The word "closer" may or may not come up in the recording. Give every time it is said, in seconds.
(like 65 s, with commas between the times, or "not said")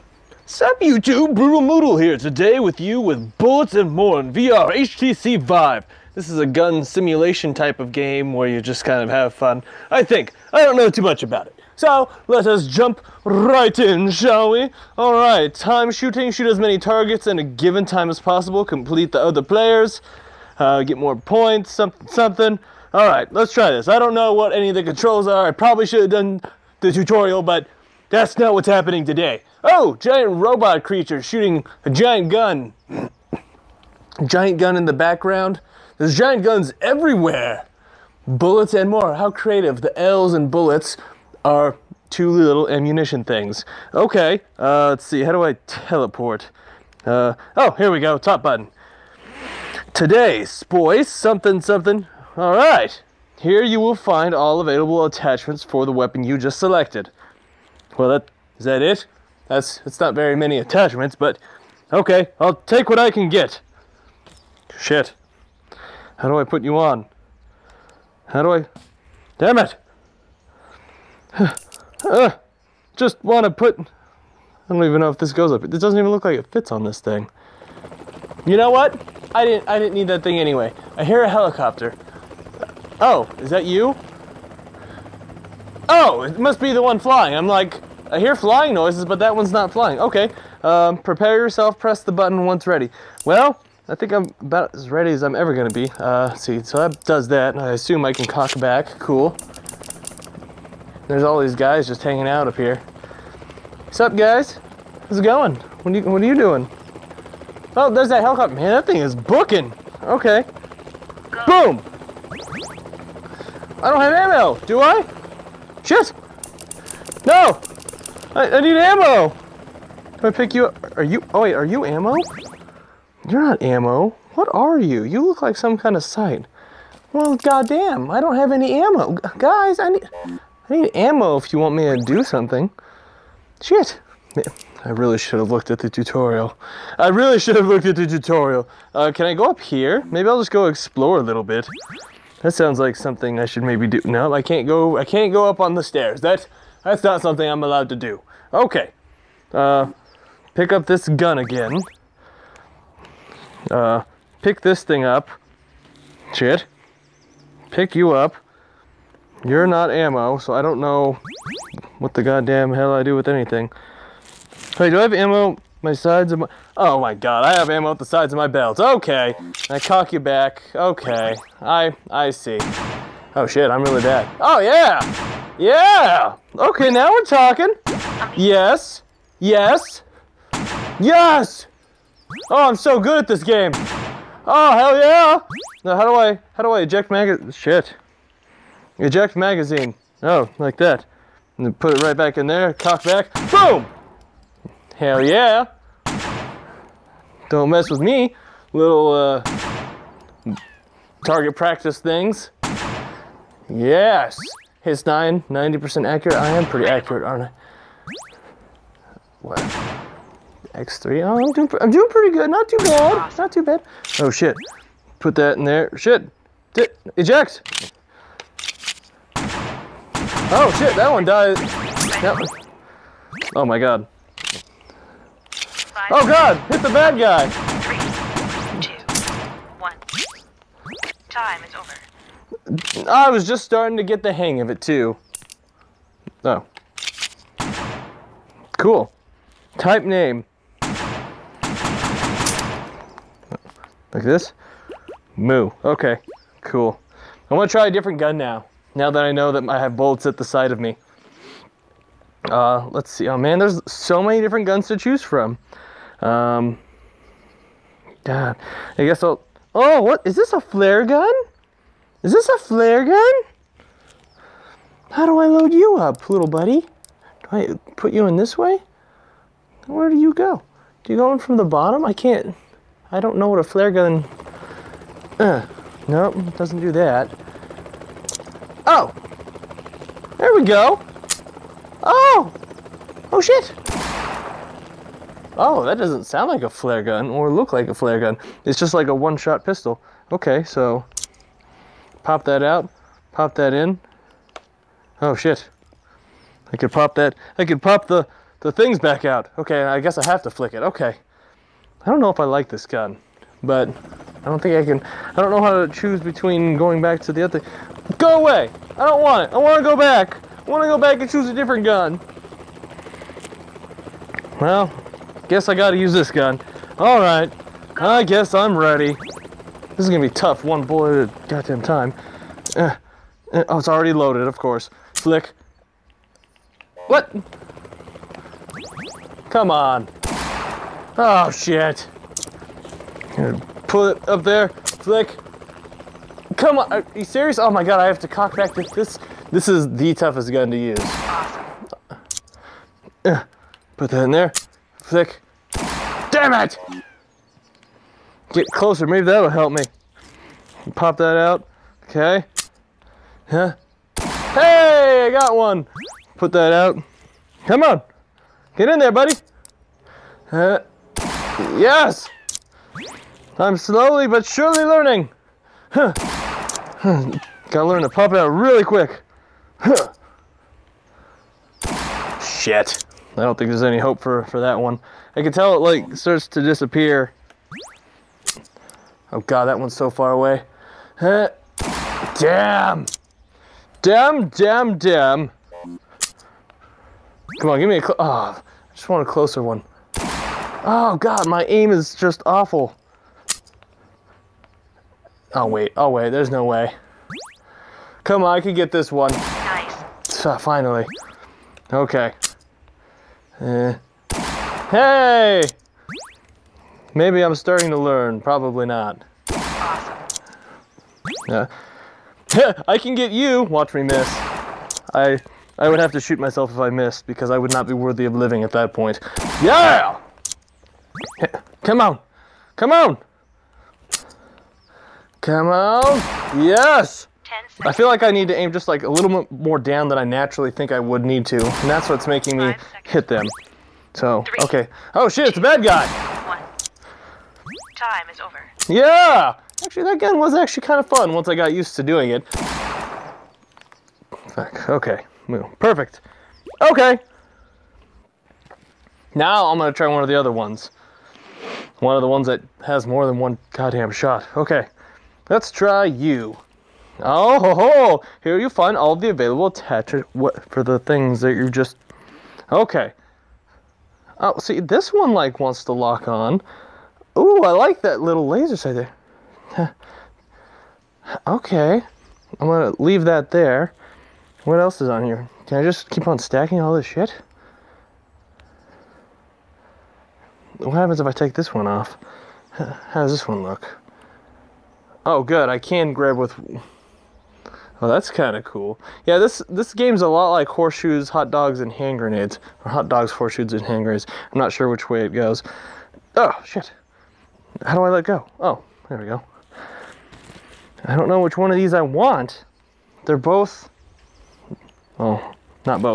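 348 s, 389 s.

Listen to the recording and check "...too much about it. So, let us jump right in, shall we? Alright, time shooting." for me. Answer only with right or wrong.
right.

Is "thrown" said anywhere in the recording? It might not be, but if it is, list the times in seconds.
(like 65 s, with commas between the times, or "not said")
not said.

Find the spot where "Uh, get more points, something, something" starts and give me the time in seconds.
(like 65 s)
20 s.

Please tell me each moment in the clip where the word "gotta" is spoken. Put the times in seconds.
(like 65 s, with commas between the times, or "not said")
315 s, 367 s.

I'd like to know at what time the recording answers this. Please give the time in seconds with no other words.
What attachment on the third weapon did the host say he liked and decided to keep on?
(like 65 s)
468 s.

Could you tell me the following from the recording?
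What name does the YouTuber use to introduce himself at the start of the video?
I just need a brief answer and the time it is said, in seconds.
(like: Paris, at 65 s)
Brutal Mootal, at 1 s.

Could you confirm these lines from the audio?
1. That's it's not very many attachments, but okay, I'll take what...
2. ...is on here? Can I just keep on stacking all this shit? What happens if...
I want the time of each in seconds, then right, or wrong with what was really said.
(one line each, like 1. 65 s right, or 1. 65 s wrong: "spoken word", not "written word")
1. 59 s right
2. 475 s right.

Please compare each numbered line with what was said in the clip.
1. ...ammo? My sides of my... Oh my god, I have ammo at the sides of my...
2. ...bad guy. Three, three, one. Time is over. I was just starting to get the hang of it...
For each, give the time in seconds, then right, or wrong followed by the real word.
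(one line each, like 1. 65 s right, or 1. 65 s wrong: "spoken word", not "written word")
1. 165 s right
2. 226 s wrong: "two", not "three".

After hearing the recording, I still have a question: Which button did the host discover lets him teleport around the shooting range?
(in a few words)
Top button.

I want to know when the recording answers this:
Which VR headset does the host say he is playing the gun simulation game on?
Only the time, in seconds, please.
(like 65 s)
4 s.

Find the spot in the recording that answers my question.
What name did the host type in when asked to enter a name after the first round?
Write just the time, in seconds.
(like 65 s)
245 s.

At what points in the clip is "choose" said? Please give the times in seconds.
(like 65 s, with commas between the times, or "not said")
254 s, 305 s, 311 s.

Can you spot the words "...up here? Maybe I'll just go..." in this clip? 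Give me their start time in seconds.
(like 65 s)
139 s.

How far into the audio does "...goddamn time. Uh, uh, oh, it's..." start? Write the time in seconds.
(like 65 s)
321 s.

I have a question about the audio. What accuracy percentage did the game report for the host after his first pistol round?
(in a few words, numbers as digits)
90%.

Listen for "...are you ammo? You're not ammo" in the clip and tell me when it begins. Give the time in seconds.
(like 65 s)
121 s.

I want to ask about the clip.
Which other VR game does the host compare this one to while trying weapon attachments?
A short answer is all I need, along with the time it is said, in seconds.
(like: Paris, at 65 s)
Hot Dogs, Horseshoes and Hand Grenades, at 490 s.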